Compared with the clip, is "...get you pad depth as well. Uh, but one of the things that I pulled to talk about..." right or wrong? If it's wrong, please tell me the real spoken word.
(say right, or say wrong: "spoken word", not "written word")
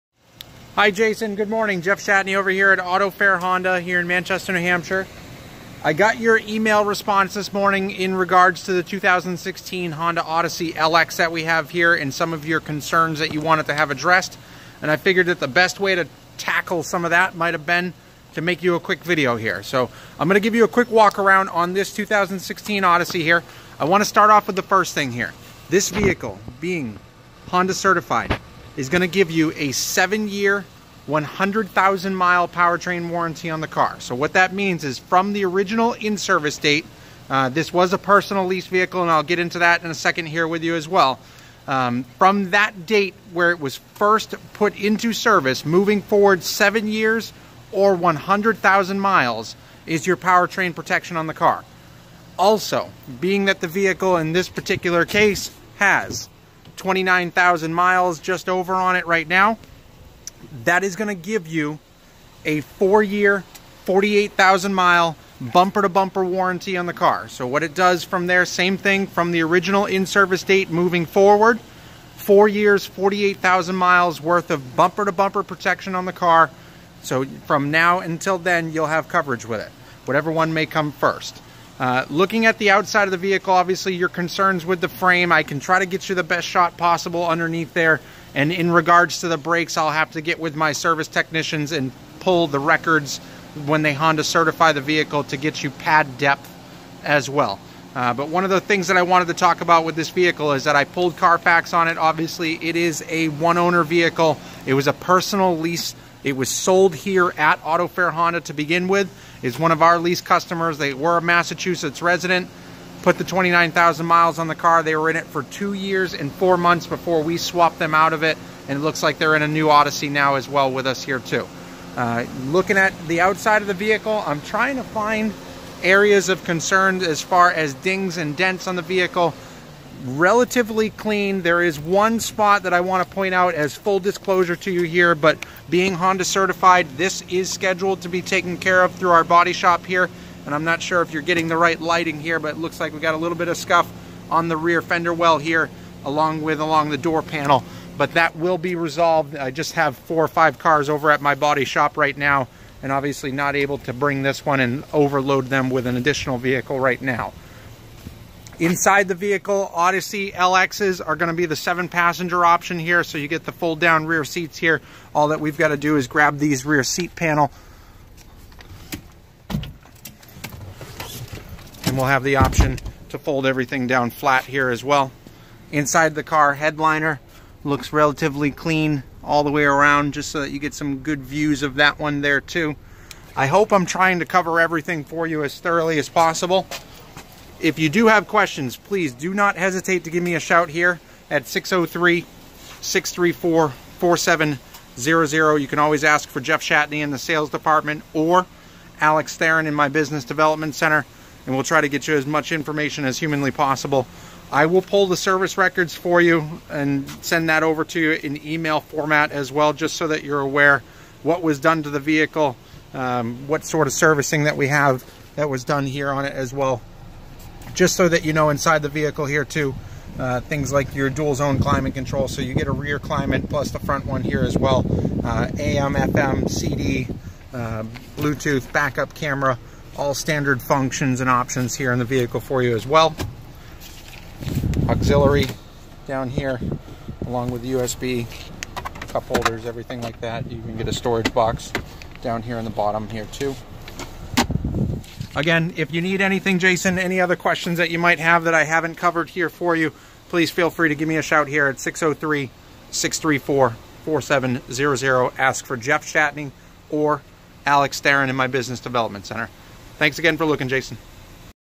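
wrong: "wanted", not "pulled".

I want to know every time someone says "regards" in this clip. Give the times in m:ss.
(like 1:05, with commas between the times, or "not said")
0:08, 1:28.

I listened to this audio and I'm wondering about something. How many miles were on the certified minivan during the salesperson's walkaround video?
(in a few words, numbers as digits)
29,000.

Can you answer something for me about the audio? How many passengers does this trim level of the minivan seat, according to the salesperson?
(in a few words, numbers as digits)
7.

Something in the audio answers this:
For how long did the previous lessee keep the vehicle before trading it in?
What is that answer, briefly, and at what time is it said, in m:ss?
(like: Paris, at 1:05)
2 years and 4 months, at 1:55.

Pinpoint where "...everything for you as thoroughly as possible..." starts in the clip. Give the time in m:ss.
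3:04.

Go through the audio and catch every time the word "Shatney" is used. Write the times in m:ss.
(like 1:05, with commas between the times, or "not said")
0:01, 3:16, 4:16.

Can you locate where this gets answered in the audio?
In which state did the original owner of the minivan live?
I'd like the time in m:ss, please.
1:51.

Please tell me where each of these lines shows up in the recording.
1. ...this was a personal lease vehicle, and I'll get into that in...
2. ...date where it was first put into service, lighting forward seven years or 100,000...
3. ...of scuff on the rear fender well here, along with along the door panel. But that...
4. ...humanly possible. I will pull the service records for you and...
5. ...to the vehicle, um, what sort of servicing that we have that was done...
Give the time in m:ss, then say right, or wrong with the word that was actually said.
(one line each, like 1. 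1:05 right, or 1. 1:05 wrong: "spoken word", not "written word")
1. 0:37 right
2. 0:42 wrong: "moving", not "lighting"
3. 2:23 right
4. 3:23 right
5. 3:31 right.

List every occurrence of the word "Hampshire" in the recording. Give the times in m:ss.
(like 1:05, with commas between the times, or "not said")
0:04.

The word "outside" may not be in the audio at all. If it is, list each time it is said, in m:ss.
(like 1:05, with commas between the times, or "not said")
1:22, 2:03.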